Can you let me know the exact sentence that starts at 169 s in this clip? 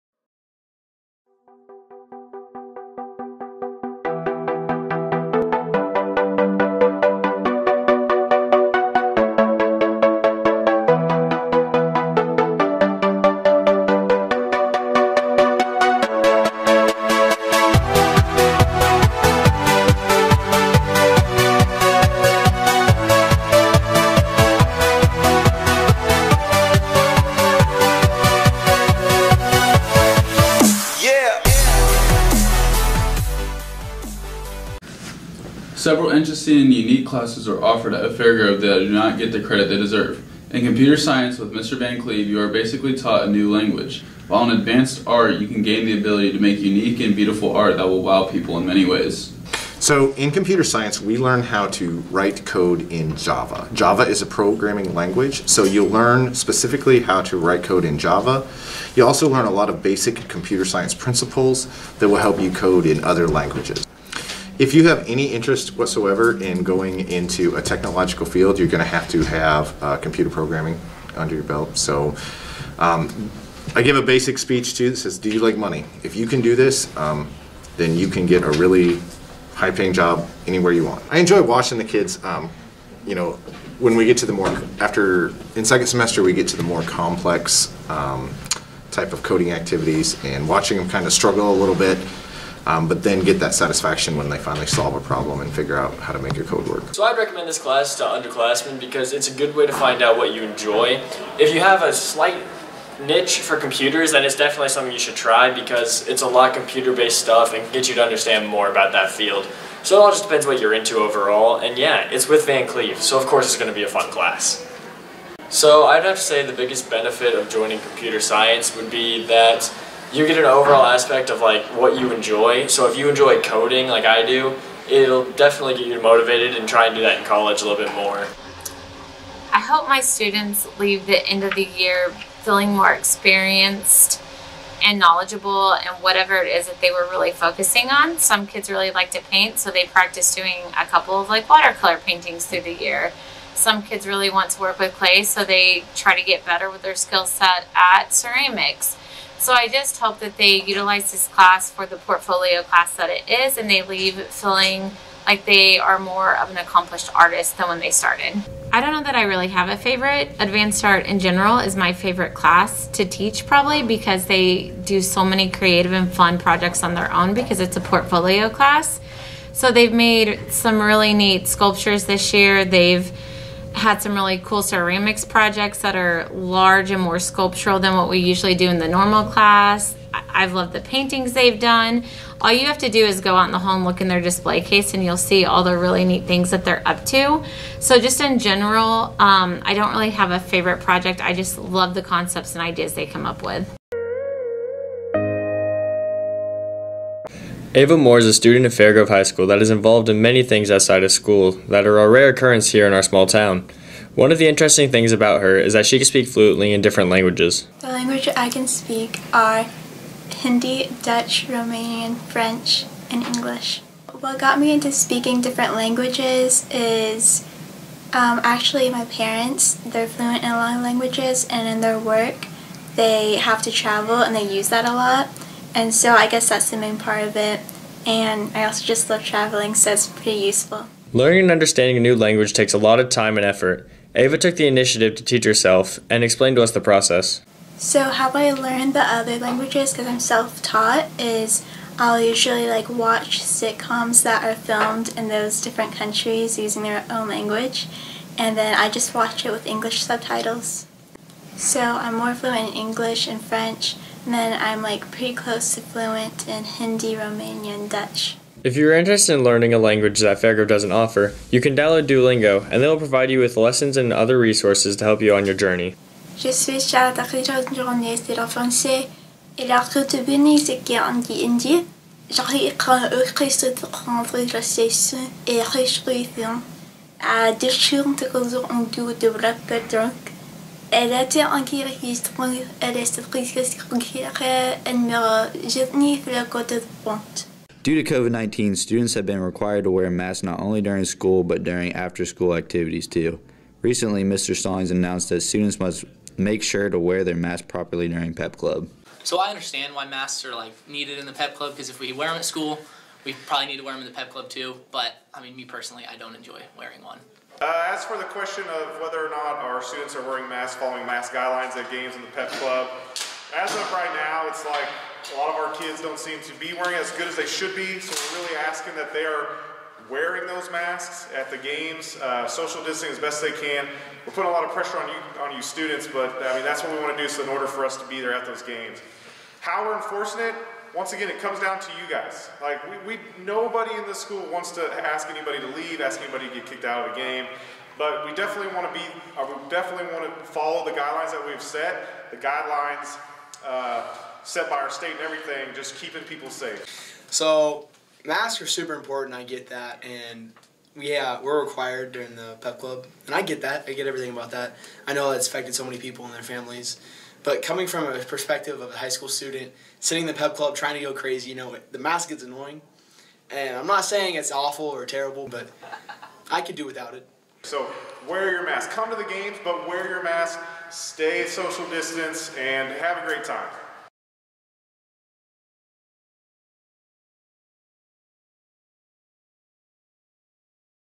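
So they've made some really neat sculptures this year.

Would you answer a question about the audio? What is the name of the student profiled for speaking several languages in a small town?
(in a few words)
Ava Moore.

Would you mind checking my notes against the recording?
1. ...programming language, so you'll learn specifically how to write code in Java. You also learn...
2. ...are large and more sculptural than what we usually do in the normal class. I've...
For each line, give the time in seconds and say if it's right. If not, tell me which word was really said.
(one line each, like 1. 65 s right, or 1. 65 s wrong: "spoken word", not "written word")
1. 54 s right
2. 175 s right.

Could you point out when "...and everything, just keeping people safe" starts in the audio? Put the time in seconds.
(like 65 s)
345 s.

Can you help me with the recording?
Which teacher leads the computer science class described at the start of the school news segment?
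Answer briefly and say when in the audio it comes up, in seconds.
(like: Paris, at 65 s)
Mr. Van Cleve, at 41 s.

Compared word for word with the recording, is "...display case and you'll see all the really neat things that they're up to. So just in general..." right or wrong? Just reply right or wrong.
right.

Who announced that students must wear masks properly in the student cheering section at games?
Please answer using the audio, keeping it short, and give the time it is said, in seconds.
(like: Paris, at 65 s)
Mr. Stallings, at 294 s.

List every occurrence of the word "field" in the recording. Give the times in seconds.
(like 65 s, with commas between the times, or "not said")
68 s, 109 s.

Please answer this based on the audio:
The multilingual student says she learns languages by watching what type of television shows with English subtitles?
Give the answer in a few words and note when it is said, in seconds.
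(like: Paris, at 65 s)
sitcoms, at 243 s.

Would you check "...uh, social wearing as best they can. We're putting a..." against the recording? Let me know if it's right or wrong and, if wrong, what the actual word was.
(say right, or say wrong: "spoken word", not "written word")
wrong: "distancing", not "wearing".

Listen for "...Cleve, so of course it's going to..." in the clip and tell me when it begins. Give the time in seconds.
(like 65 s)
112 s.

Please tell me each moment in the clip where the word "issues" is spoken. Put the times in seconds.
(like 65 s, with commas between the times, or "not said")
not said.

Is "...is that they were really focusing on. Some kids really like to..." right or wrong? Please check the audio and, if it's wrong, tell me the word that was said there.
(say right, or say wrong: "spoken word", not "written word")
right.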